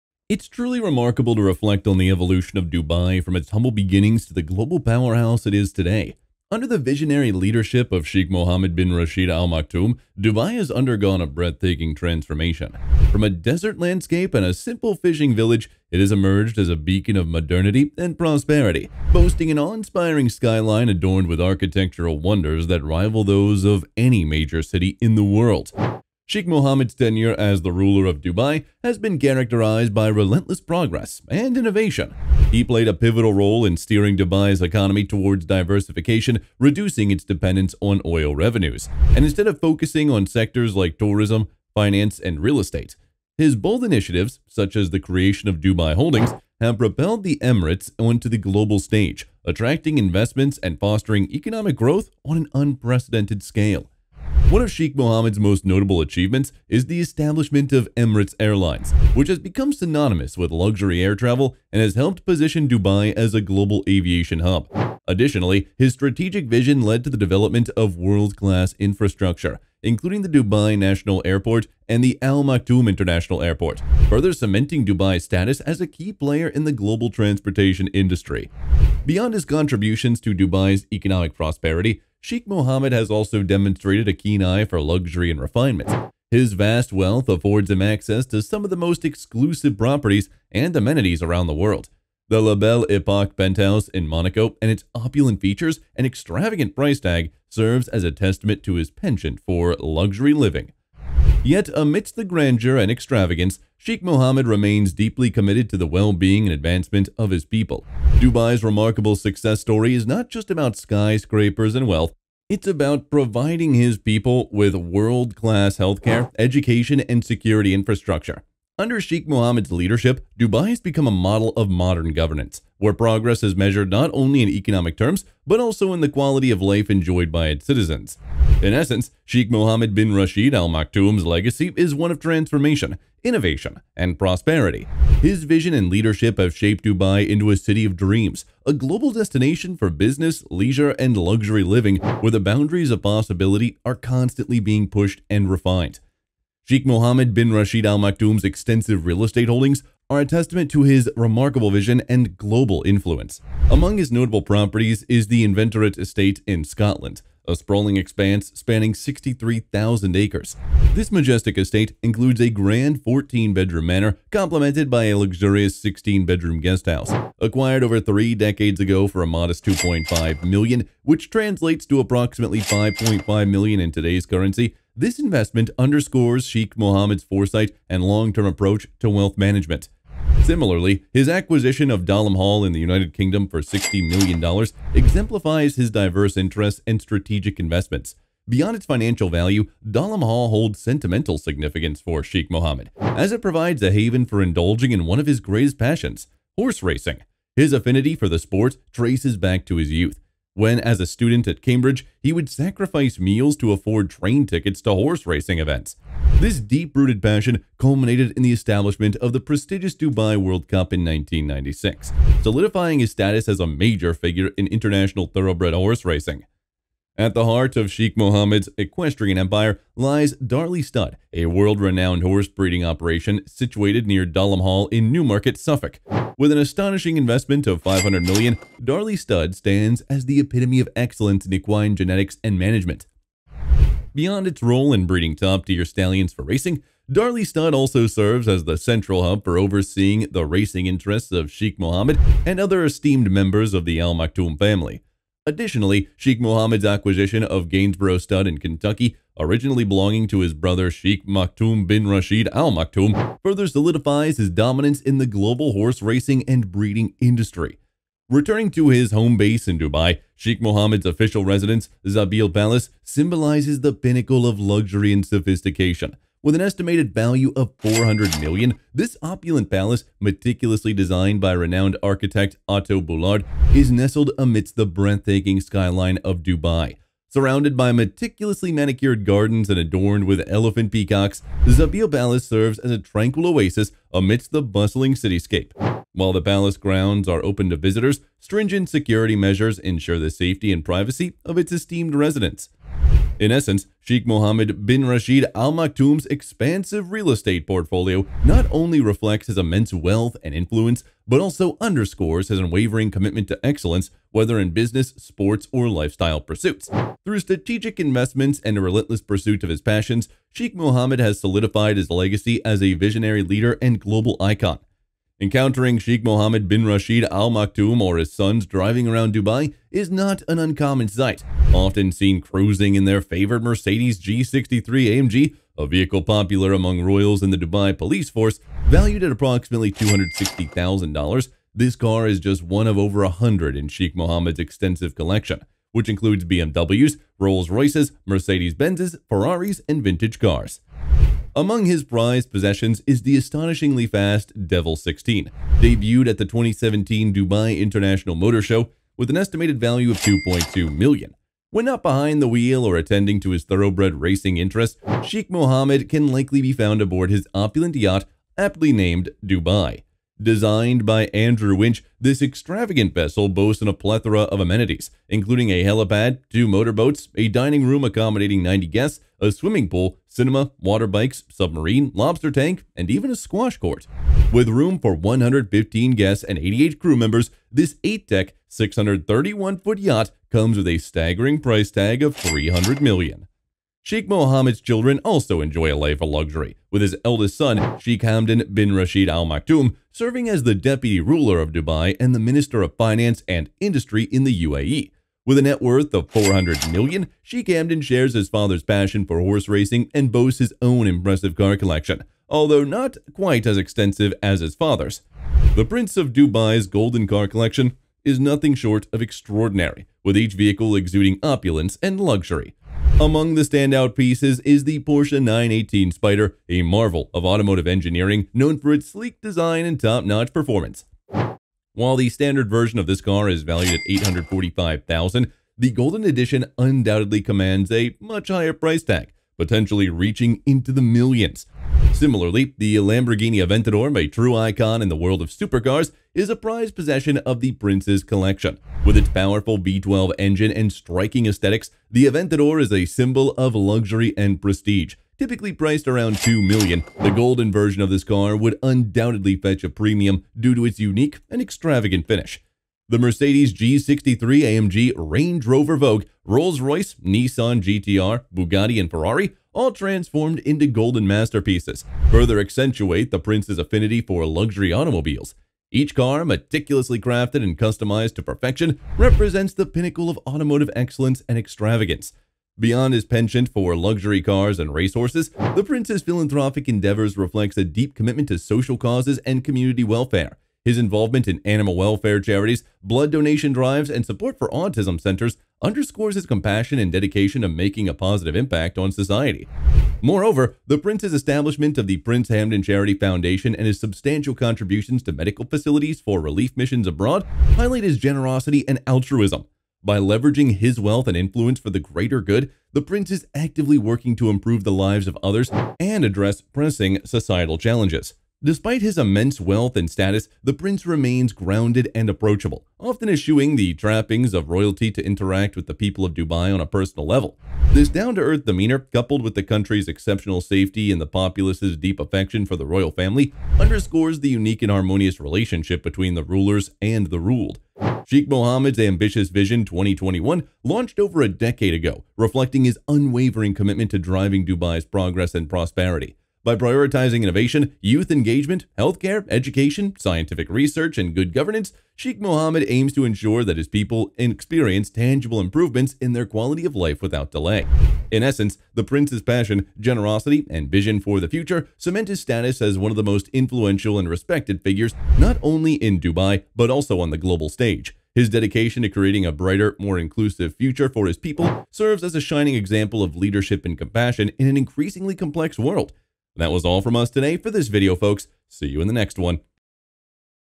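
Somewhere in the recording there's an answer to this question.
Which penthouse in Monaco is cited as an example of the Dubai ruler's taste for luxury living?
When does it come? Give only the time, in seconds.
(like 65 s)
92 s.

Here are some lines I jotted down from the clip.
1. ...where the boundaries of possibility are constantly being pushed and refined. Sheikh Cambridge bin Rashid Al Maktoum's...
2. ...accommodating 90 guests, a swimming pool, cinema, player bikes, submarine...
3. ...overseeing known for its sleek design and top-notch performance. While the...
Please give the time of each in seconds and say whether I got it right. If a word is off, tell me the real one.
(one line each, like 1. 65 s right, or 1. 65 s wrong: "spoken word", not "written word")
1. 141 s wrong: "Mohammed", not "Cambridge"
2. 368 s wrong: "water", not "player"
3. 417 s wrong: "engineering", not "overseeing".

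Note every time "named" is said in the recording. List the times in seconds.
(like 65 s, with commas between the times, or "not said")
358 s.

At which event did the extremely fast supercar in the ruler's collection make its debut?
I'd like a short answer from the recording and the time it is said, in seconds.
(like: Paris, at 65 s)
2017 Dubai International Motor Show, at 346 s.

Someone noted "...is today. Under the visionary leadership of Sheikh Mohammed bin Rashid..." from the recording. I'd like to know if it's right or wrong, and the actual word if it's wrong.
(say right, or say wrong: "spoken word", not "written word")
right.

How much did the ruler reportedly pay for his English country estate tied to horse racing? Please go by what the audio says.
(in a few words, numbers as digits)
$60 million.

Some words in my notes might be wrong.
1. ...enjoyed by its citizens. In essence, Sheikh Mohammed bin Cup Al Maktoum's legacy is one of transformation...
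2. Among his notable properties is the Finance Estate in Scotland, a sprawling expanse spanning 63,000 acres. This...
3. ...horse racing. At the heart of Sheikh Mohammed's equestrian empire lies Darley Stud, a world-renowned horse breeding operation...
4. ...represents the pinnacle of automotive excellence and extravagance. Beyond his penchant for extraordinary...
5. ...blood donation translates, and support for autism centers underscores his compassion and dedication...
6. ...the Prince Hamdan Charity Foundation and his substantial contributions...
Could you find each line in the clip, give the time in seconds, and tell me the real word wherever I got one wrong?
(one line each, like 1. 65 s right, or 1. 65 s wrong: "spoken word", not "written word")
1. 126 s wrong: "Rashid", not "Cup"
2. 153 s wrong: "Inverinate", not "Finance"
3. 215 s right
4. 469 s wrong: "luxury", not "extraordinary"
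5. 483 s wrong: "drives", not "translates"
6. 492 s right.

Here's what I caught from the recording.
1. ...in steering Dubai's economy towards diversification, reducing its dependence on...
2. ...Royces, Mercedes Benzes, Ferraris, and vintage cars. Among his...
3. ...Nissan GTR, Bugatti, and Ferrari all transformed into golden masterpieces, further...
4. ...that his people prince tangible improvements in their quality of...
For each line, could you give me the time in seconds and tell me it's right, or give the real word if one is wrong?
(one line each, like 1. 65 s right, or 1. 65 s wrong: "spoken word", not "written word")
1. 33 s right
2. 337 s right
3. 457 s right
4. 543 s wrong: "experience", not "prince".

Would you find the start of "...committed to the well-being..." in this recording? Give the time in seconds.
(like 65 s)
105 s.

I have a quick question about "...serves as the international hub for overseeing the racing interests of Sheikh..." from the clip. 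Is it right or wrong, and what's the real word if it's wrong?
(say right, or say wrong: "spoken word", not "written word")
wrong: "central", not "international".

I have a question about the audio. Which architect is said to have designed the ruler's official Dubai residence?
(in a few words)
Otto Boulard.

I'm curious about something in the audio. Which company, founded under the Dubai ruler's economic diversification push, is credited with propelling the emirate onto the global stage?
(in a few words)
Dubai Holdings.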